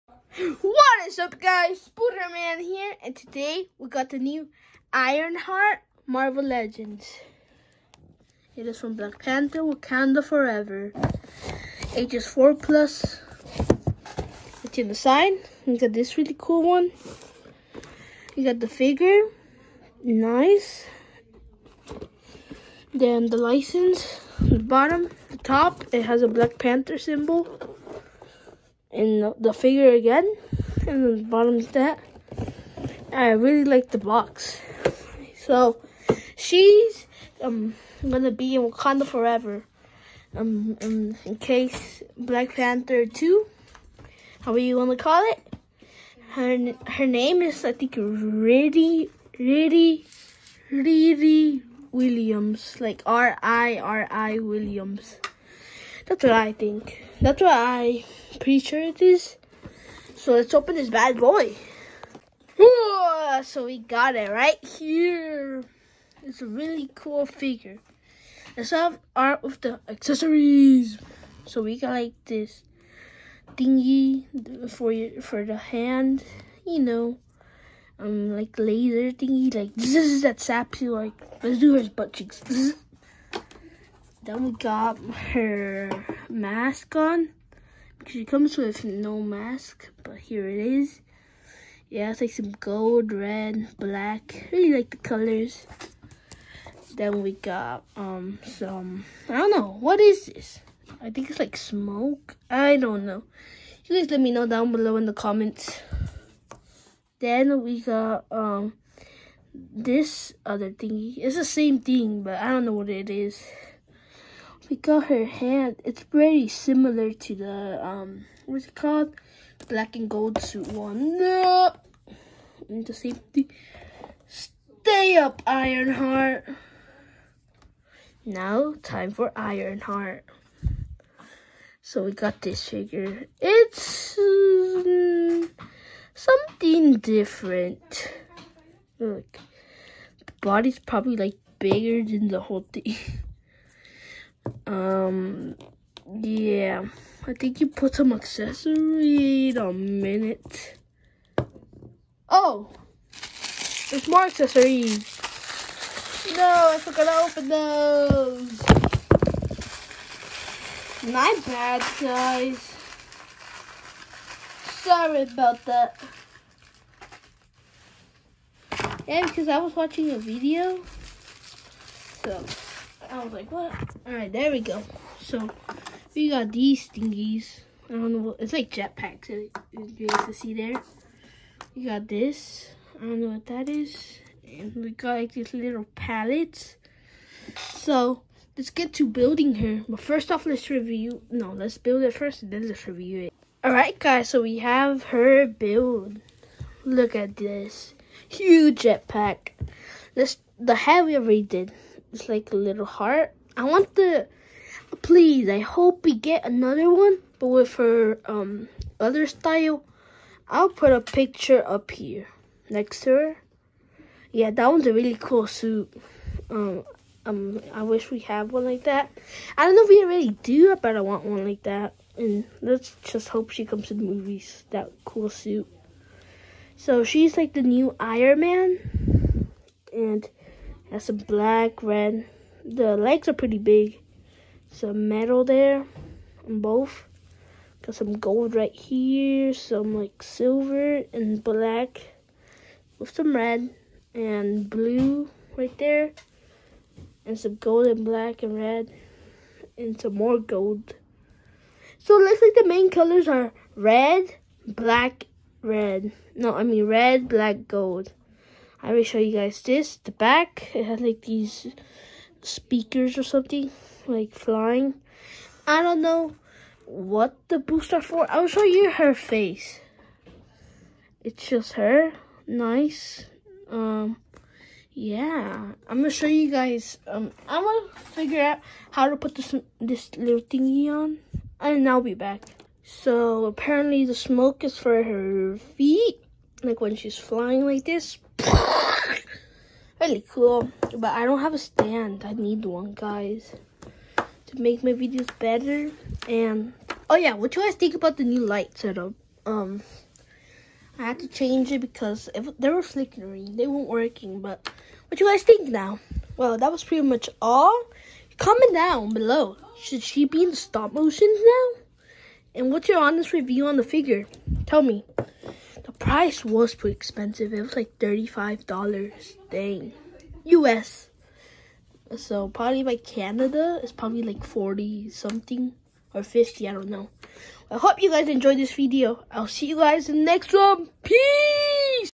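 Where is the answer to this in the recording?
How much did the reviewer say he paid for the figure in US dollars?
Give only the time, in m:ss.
5:17.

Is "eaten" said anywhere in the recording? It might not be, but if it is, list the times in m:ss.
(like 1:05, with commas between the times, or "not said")
not said.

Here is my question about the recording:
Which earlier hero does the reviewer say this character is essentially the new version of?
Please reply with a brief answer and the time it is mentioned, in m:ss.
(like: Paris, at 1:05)
Iron Man, at 3:47.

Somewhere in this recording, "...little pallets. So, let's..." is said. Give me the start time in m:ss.
3:05.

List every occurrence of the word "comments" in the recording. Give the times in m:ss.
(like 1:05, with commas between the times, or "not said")
1:45, 5:08.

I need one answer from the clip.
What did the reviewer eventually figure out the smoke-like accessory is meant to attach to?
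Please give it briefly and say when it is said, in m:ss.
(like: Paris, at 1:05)
Her feet, at 4:45.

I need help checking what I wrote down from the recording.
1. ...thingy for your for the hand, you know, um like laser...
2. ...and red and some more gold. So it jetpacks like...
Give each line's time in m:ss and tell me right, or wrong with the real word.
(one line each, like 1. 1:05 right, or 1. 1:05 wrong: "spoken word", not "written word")
1. 1:13 right
2. 4:08 wrong: "looks", not "jetpacks".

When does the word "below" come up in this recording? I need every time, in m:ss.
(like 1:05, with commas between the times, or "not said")
1:44, 5:09.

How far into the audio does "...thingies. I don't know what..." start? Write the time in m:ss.
2:56.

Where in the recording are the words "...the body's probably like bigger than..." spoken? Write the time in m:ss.
2:20.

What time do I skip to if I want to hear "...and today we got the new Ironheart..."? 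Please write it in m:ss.
0:03.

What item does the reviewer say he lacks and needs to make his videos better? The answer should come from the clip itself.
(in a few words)
A stand.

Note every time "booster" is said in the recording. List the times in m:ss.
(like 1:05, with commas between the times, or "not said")
4:27.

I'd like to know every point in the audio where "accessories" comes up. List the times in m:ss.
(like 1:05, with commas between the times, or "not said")
1:09, 2:28, 2:34.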